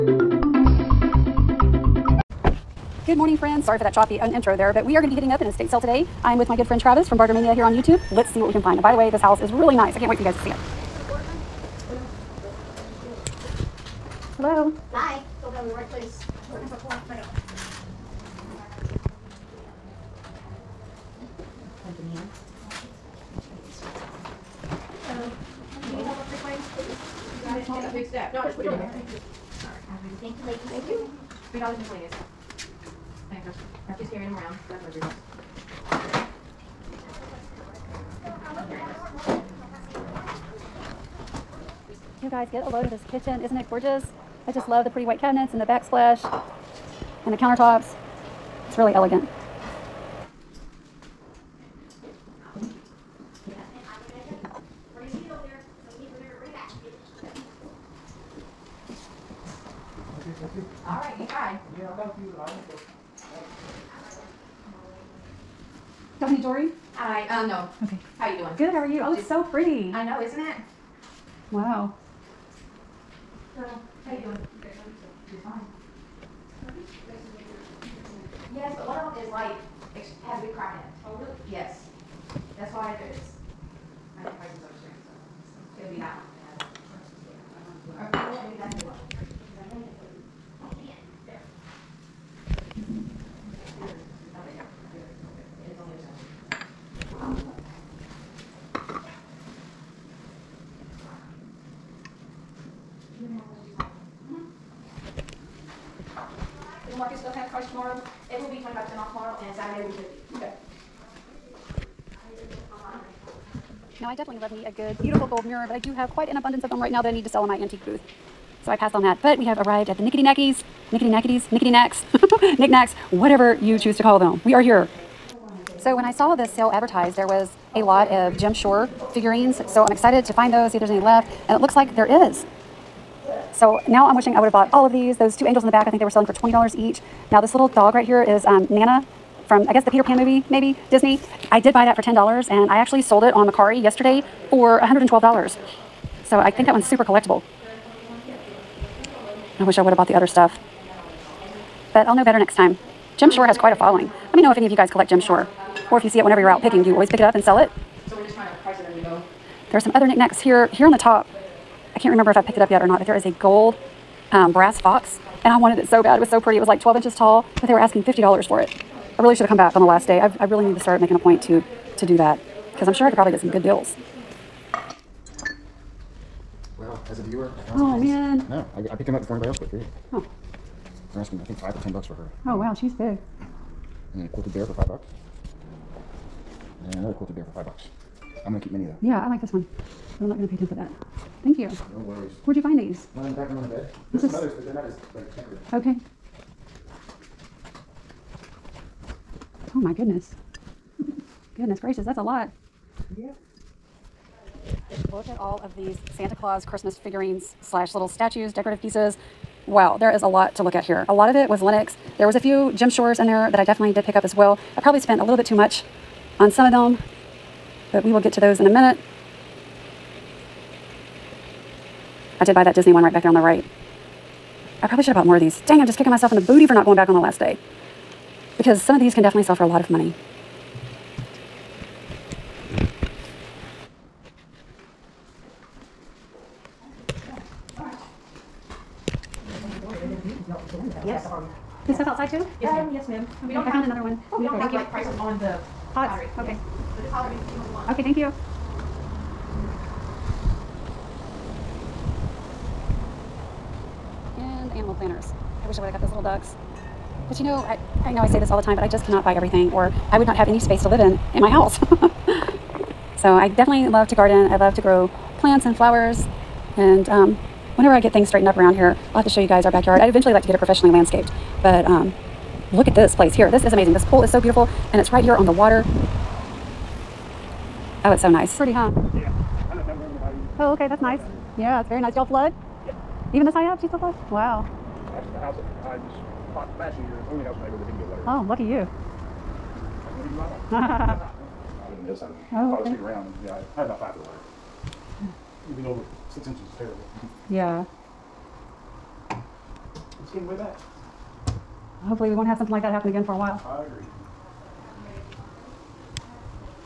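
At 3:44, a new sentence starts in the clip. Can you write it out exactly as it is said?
I probably should have bought more of these.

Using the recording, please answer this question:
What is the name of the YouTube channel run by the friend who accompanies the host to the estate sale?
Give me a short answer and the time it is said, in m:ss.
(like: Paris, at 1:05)
Bartermania, at 0:07.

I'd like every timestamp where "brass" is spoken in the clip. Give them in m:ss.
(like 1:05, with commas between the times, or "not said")
2:44.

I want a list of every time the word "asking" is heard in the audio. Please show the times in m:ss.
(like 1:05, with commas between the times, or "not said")
2:47, 3:01.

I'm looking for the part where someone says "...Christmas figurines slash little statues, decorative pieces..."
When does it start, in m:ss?
3:26.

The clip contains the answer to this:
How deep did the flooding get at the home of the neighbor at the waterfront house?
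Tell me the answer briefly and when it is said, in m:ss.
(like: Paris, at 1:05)
5 foot, at 4:53.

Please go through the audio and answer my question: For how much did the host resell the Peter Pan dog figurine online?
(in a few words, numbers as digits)
$112.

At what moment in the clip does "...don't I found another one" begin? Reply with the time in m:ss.
4:03.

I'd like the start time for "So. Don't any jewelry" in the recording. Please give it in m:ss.
1:03.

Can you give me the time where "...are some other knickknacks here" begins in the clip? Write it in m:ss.
2:39.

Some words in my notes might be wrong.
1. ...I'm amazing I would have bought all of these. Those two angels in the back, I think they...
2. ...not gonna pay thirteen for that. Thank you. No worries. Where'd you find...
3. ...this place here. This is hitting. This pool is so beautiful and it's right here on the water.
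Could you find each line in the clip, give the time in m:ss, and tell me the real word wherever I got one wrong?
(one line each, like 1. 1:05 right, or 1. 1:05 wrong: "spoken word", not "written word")
1. 2:14 wrong: "wishing", not "amazing"
2. 3:10 wrong: "ten", not "thirteen"
3. 4:32 wrong: "amazing", not "hitting".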